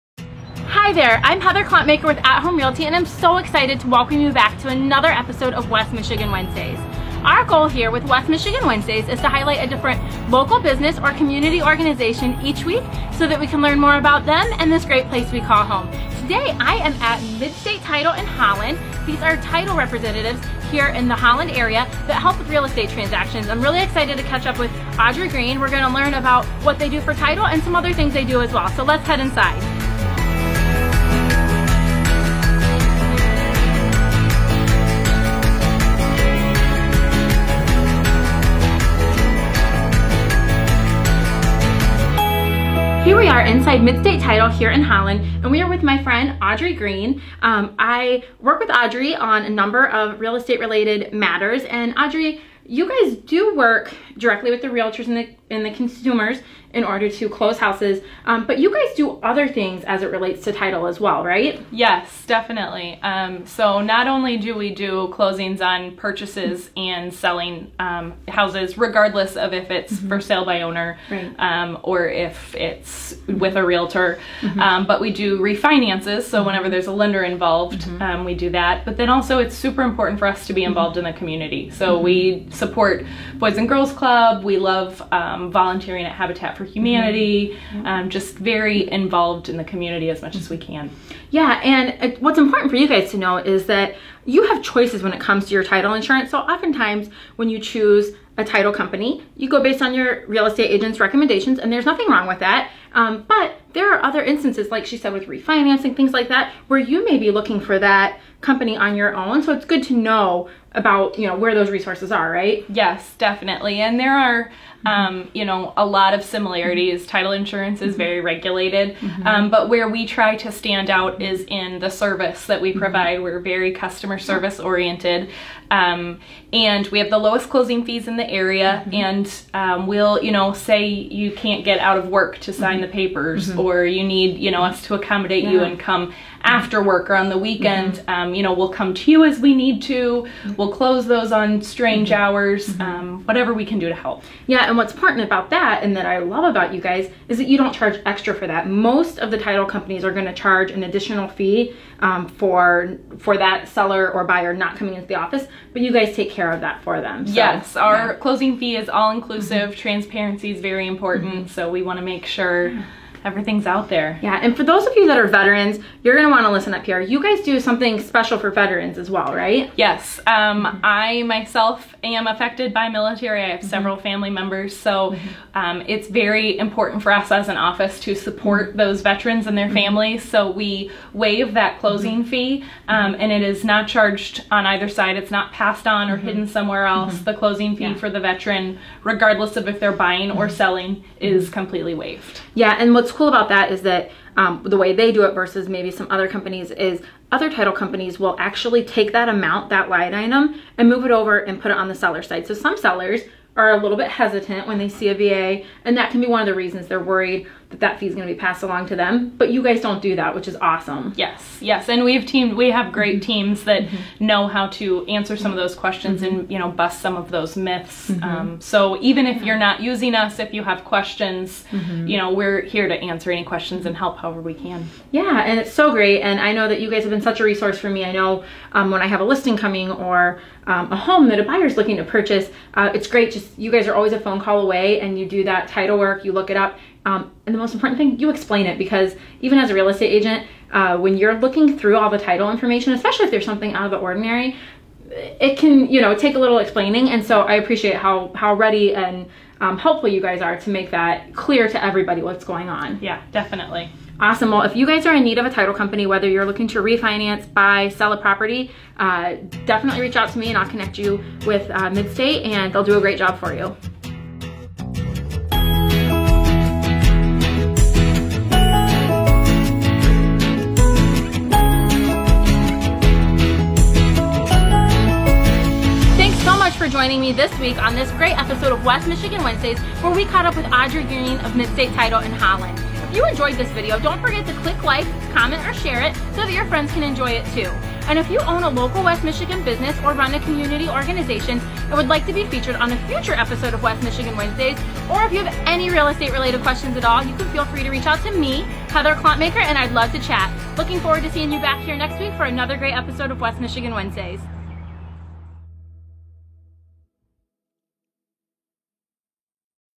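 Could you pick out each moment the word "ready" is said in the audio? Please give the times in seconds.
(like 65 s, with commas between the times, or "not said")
248 s.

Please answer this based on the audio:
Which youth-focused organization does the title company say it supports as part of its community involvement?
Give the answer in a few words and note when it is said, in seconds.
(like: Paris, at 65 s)
Boys and Girls Club, at 83 s.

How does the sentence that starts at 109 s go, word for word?
So it's good to know about, you know, where those resources are, right?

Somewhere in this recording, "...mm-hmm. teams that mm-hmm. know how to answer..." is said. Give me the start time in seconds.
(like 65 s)
213 s.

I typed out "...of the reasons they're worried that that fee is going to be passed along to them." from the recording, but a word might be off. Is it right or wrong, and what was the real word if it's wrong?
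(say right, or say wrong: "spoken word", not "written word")
right.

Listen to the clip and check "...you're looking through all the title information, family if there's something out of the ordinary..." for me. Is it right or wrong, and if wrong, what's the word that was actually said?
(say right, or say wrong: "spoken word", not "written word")
wrong: "especially", not "family".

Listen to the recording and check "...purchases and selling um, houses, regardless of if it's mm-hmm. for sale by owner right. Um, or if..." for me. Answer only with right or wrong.
right.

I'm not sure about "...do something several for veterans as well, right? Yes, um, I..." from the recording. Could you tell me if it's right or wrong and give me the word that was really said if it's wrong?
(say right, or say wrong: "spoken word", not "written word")
wrong: "special", not "several".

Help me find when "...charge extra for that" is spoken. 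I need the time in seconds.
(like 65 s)
147 s.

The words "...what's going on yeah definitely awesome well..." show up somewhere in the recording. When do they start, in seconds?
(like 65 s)
252 s.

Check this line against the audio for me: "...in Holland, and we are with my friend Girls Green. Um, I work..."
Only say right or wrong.
wrong.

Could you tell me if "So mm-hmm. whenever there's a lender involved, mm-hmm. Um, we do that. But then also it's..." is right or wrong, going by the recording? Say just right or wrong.
right.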